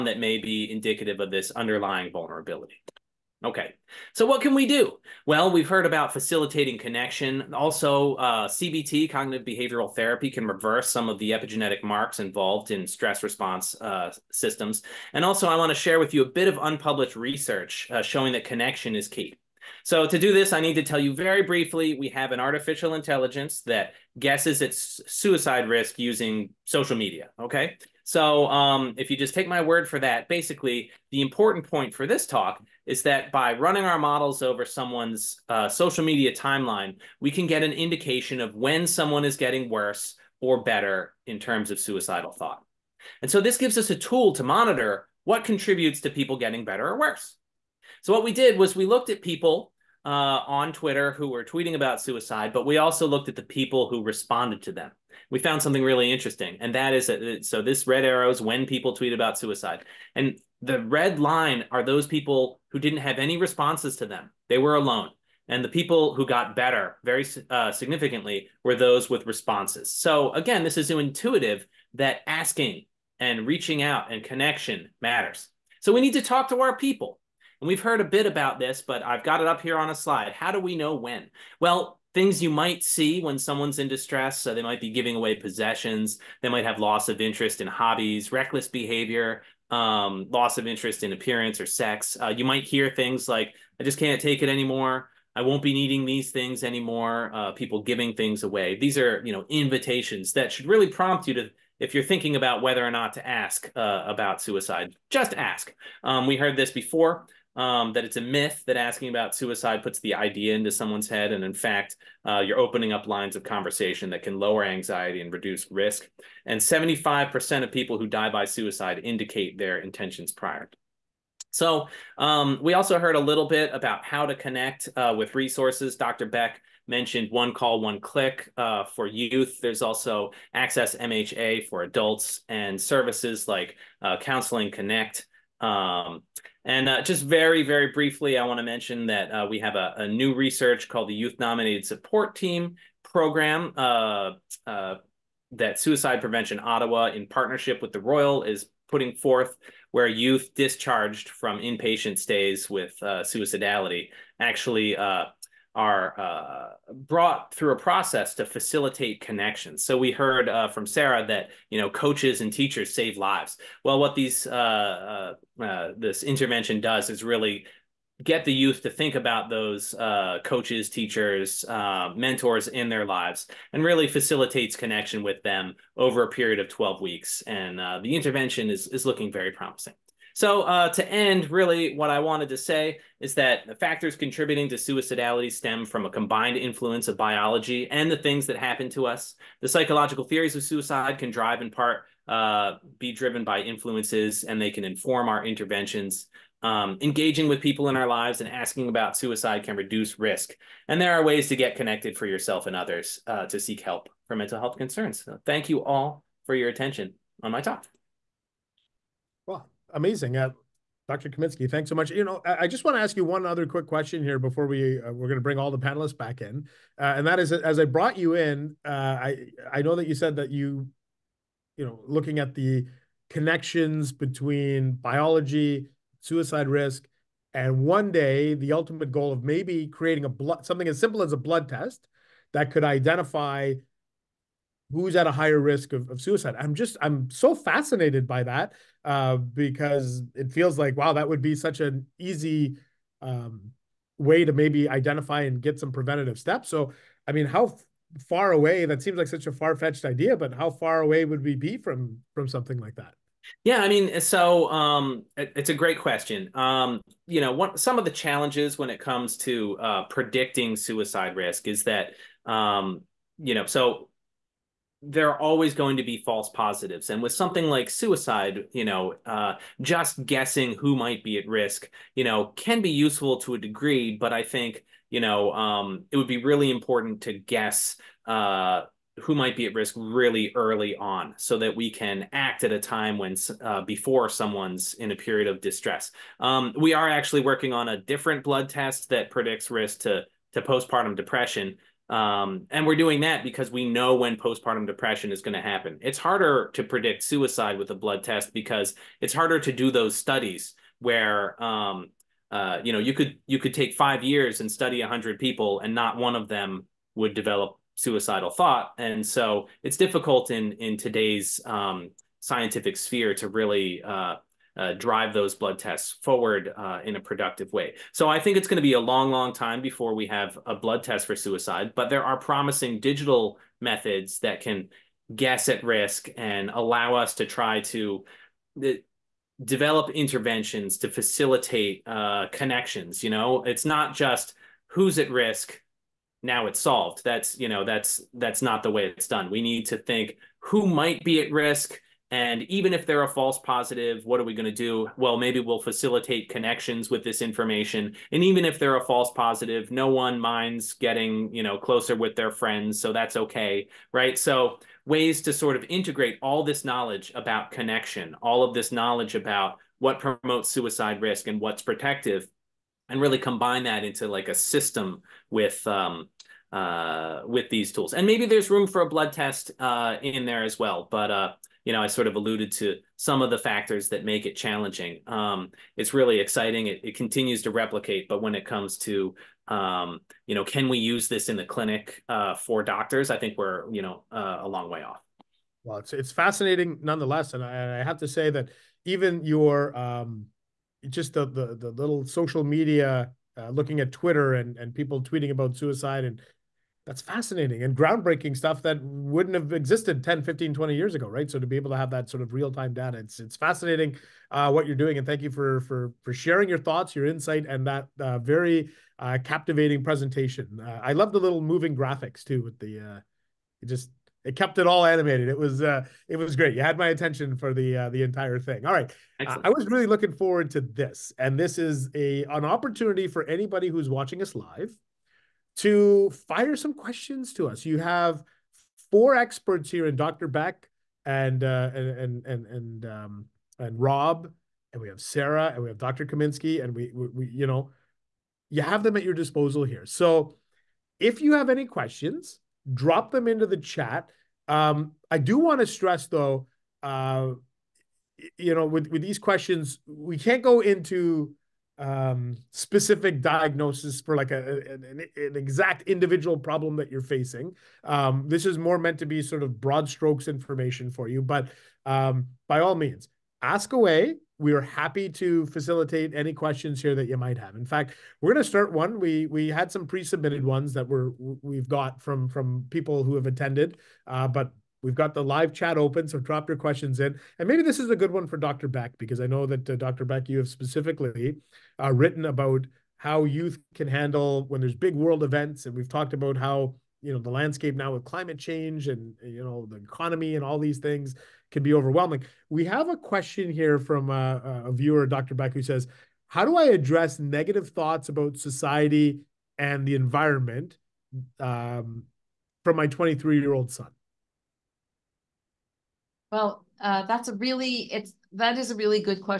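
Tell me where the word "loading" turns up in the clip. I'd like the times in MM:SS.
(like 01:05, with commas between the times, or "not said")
not said.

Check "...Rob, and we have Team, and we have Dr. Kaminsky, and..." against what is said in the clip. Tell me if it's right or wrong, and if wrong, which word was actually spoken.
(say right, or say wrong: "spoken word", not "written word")
wrong: "Sarah", not "Team".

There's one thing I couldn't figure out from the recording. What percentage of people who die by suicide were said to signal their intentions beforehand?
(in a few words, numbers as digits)
75%.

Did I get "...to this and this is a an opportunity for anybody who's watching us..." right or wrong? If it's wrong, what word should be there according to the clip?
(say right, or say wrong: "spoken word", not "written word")
right.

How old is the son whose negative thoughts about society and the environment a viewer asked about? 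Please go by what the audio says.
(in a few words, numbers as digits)
23.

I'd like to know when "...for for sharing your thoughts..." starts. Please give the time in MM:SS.
06:45.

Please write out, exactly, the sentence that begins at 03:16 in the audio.
Um, engaging with people in our lives and asking about suicide can reduce risk.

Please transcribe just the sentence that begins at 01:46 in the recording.
Um, we heard this before um, that it's a myth that asking about suicide puts the idea into someone's head.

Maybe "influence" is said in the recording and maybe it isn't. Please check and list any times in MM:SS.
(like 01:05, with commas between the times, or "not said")
03:06, 03:13.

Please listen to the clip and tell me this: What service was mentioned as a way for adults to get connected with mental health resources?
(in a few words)
Access MHA.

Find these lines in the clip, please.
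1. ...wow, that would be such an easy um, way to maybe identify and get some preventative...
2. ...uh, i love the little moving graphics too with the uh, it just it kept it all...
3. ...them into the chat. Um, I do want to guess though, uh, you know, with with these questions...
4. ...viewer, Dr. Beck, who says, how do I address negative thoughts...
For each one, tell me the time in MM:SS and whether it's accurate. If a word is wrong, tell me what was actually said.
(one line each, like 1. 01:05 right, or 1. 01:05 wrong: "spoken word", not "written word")
1. 04:00 right
2. 06:50 right
3. 07:23 wrong: "stress", not "guess"
4. 08:14 right.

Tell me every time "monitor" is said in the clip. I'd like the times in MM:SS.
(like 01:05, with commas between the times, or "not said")
00:44.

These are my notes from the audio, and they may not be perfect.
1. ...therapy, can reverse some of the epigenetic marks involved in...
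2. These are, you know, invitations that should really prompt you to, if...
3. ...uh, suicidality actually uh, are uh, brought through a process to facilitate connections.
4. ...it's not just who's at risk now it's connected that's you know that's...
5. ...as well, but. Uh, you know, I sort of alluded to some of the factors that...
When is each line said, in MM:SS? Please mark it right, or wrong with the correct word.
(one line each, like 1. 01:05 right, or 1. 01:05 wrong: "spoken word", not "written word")
1. 00:09 right
2. 01:38 right
3. 02:33 right
4. 05:33 wrong: "solved", not "connected"
5. 06:10 right.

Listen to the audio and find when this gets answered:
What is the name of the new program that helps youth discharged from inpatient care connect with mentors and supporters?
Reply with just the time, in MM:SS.
02:21.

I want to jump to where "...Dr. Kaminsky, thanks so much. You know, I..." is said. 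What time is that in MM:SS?
03:31.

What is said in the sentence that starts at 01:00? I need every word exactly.
And the red line are those people who didn't have any responses to them.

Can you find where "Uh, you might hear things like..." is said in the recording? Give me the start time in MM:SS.
01:32.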